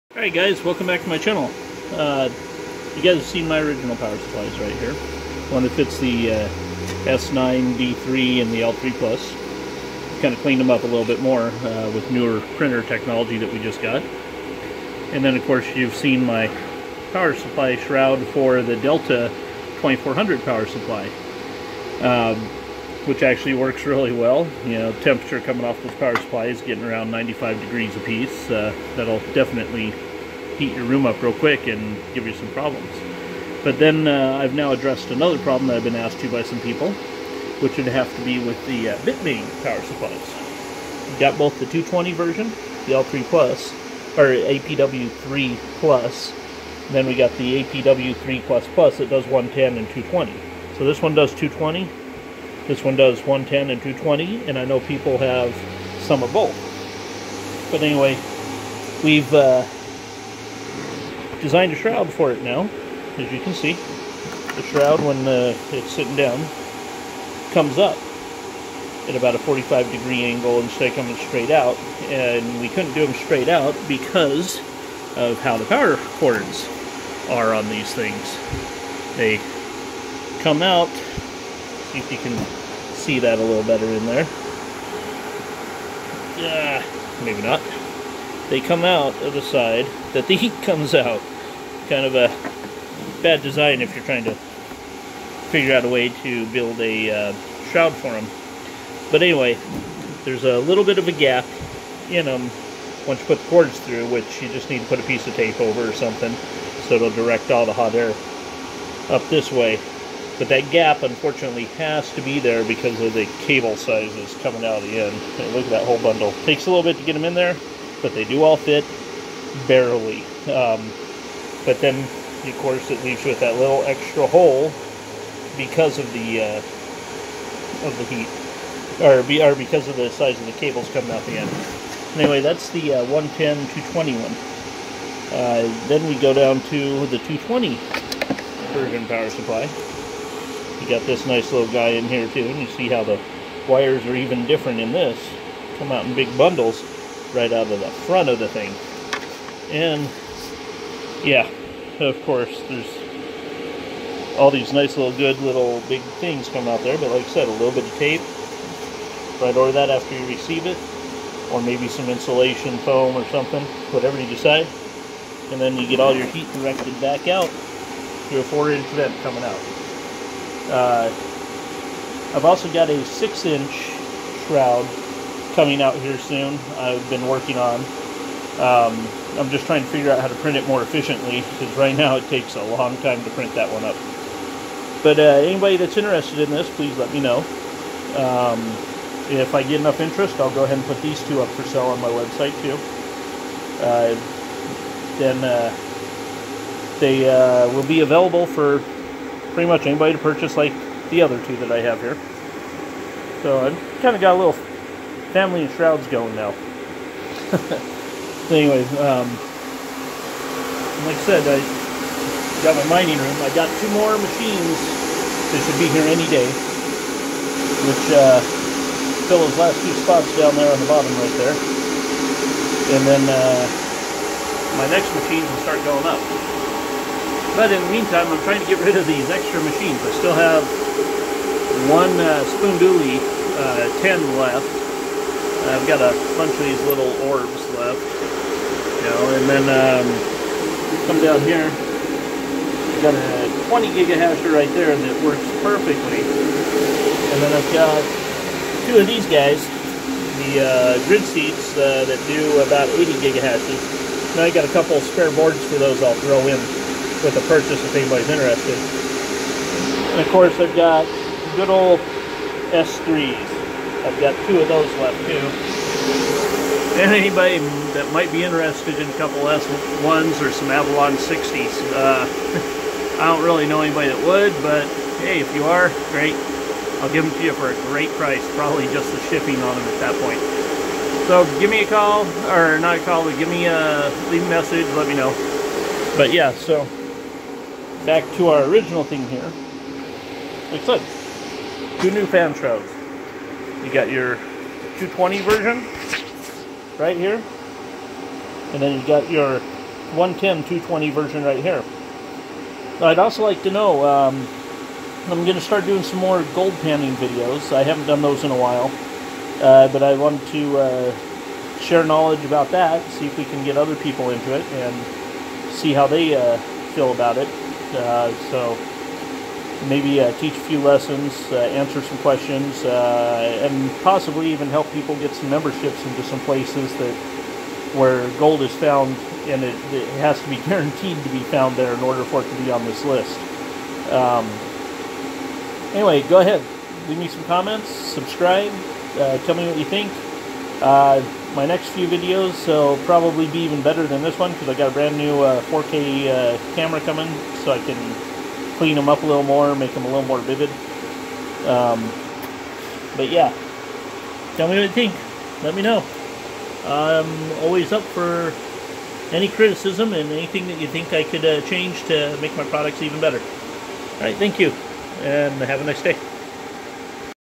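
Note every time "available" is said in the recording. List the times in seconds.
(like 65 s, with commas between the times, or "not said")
198 s.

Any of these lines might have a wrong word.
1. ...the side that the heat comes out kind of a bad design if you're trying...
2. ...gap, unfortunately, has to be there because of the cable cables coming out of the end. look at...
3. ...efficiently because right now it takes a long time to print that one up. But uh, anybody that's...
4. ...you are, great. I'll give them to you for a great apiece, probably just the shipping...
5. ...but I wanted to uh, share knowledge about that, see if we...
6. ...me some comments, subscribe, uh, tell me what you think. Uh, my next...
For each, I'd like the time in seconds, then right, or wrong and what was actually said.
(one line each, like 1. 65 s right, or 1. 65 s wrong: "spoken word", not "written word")
1. 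89 s right
2. 110 s wrong: "sizes", not "cables"
3. 180 s right
4. 275 s wrong: "price", not "apiece"
5. 309 s right
6. 337 s right.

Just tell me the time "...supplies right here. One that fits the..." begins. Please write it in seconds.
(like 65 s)
4 s.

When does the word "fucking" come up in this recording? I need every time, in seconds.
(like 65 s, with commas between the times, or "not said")
not said.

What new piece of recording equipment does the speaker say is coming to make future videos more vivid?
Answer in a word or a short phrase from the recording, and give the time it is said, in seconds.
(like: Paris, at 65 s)
4K camera, at 345 s.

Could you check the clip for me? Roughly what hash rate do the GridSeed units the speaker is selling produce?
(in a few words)
80 gigahashes.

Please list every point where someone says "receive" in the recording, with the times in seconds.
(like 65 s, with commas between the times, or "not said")
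160 s.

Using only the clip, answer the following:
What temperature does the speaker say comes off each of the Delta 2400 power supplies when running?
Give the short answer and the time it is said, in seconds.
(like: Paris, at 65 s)
95 degrees, at 27 s.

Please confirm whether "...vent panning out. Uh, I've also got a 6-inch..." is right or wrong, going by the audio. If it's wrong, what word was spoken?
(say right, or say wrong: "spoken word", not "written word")
wrong: "coming", not "panning".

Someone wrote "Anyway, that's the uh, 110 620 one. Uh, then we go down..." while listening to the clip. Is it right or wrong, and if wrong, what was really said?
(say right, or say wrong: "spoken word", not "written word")
wrong: "220", not "620".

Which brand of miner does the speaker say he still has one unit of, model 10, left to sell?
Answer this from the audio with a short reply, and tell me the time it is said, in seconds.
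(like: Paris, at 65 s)
Spondoolie, at 232 s.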